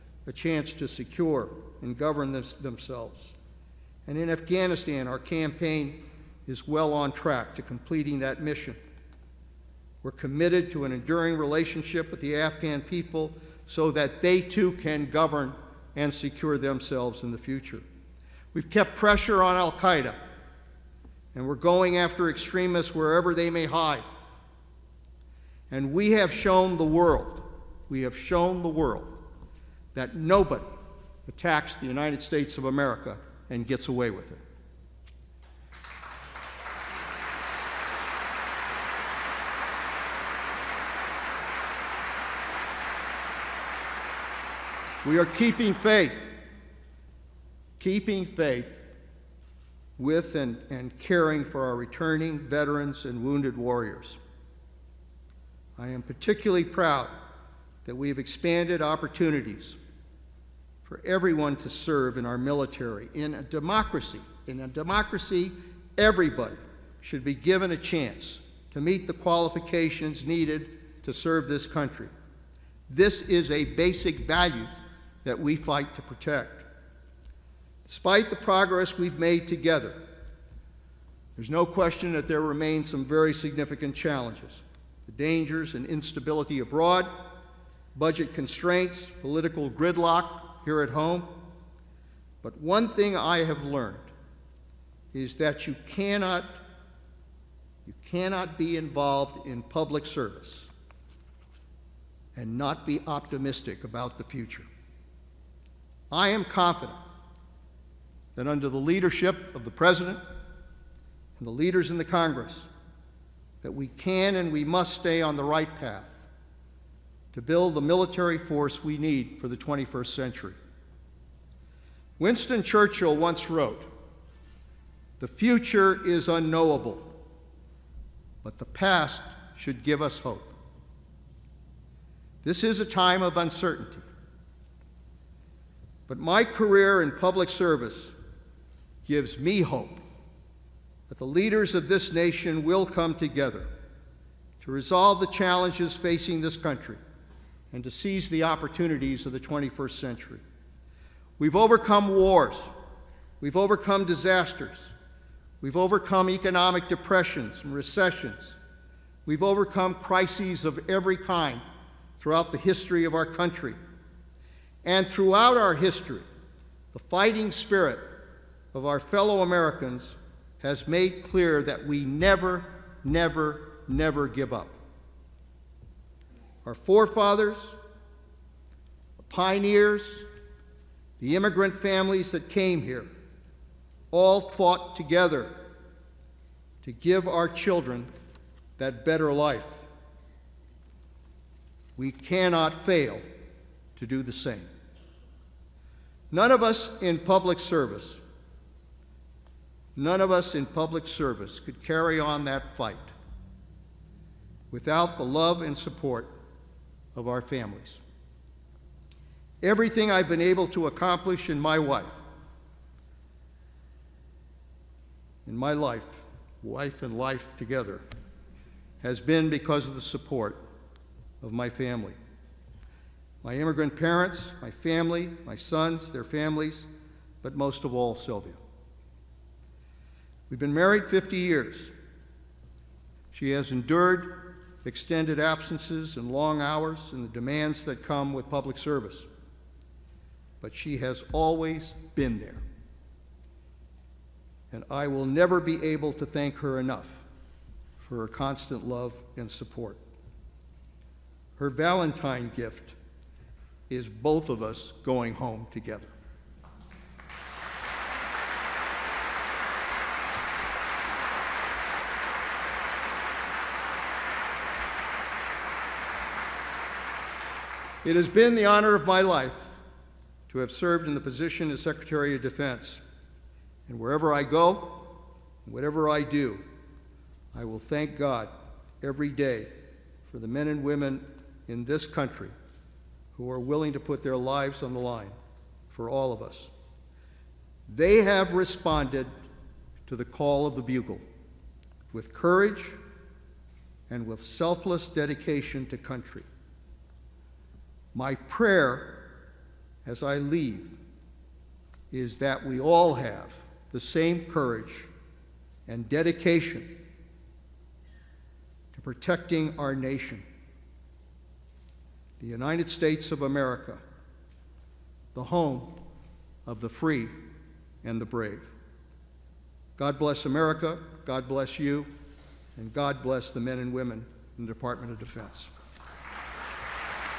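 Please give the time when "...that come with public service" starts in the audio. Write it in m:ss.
3:57.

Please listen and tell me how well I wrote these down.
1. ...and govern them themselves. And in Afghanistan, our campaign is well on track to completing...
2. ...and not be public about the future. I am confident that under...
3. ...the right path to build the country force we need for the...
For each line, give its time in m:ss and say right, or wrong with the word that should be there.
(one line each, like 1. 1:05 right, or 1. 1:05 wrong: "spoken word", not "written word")
1. 0:01 right
2. 1:42 wrong: "optimistic", not "public"
3. 1:55 wrong: "military", not "country".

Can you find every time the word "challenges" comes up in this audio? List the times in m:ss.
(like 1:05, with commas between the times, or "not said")
1:23, 2:25.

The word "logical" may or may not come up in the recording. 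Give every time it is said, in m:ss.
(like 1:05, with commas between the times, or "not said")
not said.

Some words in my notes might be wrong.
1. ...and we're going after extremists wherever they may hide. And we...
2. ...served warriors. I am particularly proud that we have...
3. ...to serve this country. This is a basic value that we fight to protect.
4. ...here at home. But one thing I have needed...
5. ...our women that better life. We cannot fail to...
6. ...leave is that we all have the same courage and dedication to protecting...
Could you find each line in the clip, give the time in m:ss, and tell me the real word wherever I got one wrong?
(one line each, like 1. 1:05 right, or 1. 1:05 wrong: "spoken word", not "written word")
1. 0:21 right
2. 0:53 wrong: "wounded", not "served"
3. 1:11 right
4. 1:30 wrong: "learned", not "needed"
5. 3:07 wrong: "children", not "women"
6. 5:00 right.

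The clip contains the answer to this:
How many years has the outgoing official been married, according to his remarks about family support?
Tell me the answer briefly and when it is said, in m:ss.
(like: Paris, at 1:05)
50, at 3:51.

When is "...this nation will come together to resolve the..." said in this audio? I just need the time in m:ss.
2:21.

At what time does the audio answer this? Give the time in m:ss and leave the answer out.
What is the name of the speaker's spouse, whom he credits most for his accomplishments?
3:48.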